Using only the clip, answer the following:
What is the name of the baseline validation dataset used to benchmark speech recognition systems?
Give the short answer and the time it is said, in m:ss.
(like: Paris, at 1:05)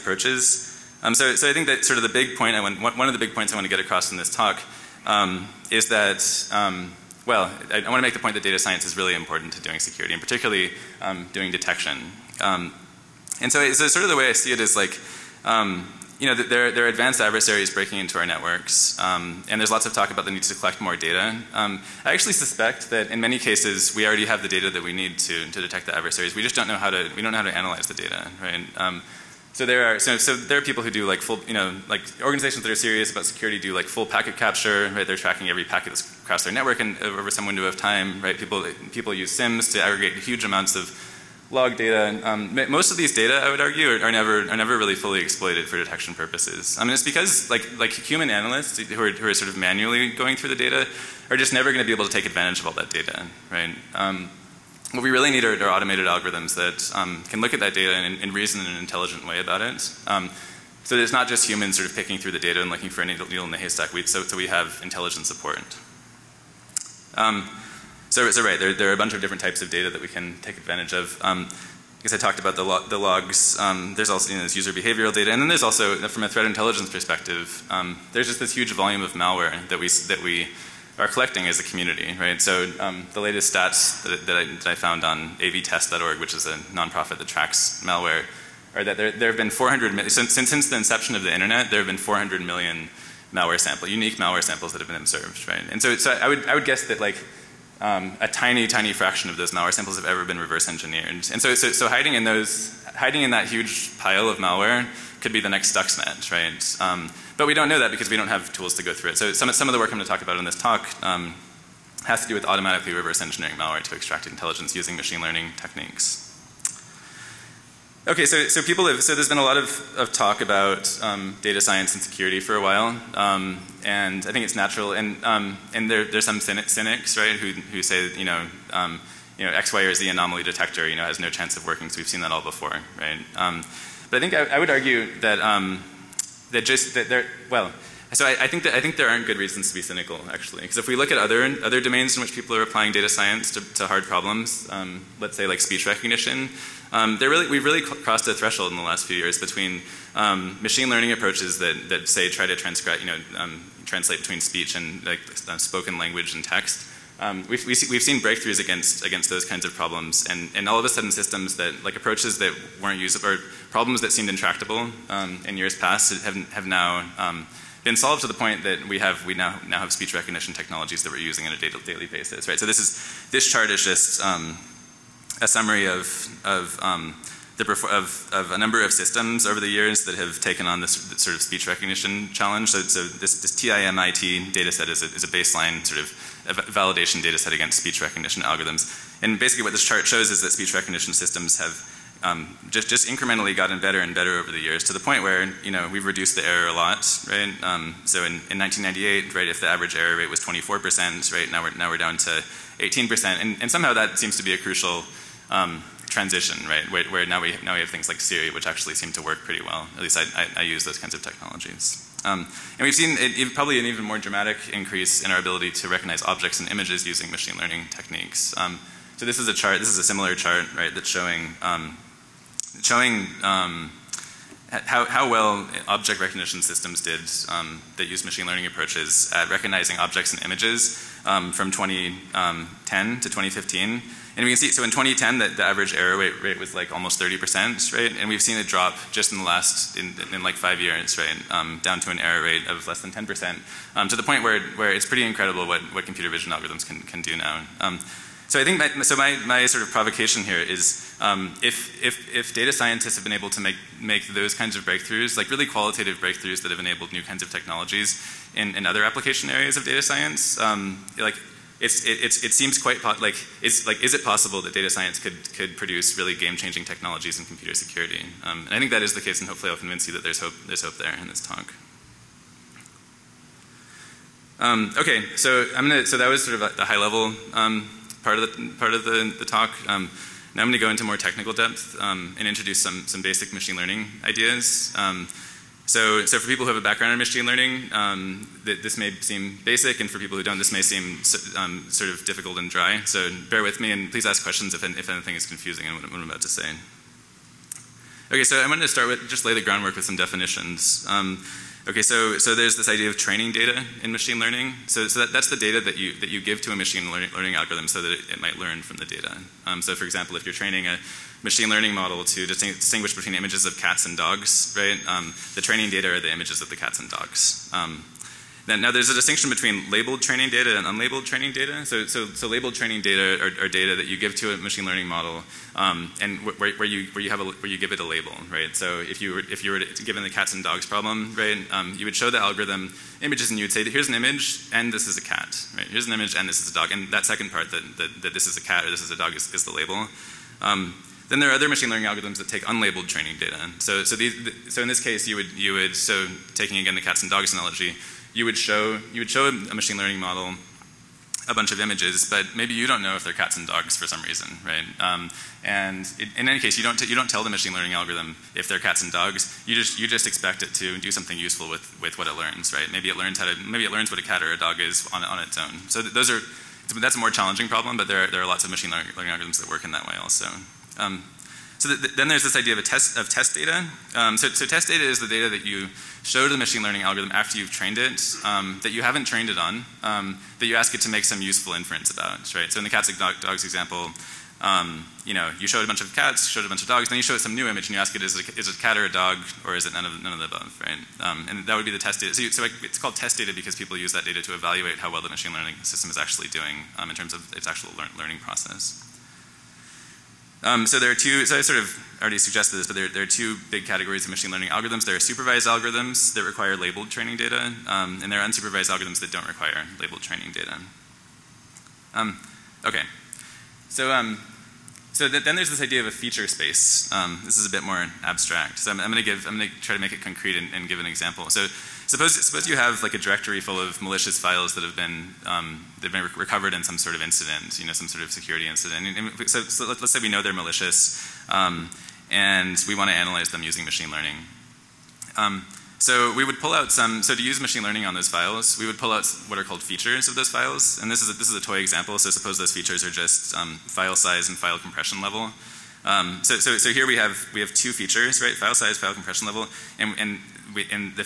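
TIMIT, at 3:03.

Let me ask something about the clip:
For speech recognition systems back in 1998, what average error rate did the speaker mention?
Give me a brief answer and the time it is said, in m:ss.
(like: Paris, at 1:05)
24%, at 3:20.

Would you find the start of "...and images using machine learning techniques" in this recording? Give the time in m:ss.
3:36.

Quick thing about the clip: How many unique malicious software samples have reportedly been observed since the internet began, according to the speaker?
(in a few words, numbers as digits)
400 million.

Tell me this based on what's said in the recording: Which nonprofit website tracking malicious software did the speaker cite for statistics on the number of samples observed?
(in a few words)
avtest.org.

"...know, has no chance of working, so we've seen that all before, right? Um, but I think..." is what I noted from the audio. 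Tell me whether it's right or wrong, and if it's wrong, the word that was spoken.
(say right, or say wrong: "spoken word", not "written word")
right.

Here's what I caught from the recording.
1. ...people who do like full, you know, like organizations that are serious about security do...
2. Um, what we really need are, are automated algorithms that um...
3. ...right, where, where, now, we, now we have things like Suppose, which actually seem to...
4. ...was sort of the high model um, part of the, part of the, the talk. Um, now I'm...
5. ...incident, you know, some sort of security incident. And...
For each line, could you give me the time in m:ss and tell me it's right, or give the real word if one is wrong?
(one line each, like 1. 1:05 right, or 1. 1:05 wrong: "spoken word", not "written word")
1. 0:30 right
2. 0:53 right
3. 3:26 wrong: "Siri", not "Suppose"
4. 4:36 wrong: "level", not "model"
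5. 7:07 right.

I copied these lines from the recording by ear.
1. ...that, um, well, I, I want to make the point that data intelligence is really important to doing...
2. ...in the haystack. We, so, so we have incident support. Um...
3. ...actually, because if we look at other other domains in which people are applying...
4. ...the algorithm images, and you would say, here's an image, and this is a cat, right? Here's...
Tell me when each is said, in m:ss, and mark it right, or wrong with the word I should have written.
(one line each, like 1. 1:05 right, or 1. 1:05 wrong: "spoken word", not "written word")
1. 0:05 wrong: "science", not "intelligence"
2. 1:03 wrong: "intelligent", not "incident"
3. 2:20 right
4. 5:32 right.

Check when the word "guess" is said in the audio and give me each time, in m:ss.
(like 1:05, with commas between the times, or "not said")
1:12, 1:36.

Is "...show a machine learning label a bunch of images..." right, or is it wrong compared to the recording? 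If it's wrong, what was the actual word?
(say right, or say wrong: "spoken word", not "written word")
wrong: "model", not "label".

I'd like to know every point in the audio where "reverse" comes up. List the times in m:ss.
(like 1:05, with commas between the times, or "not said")
1:40, 1:52.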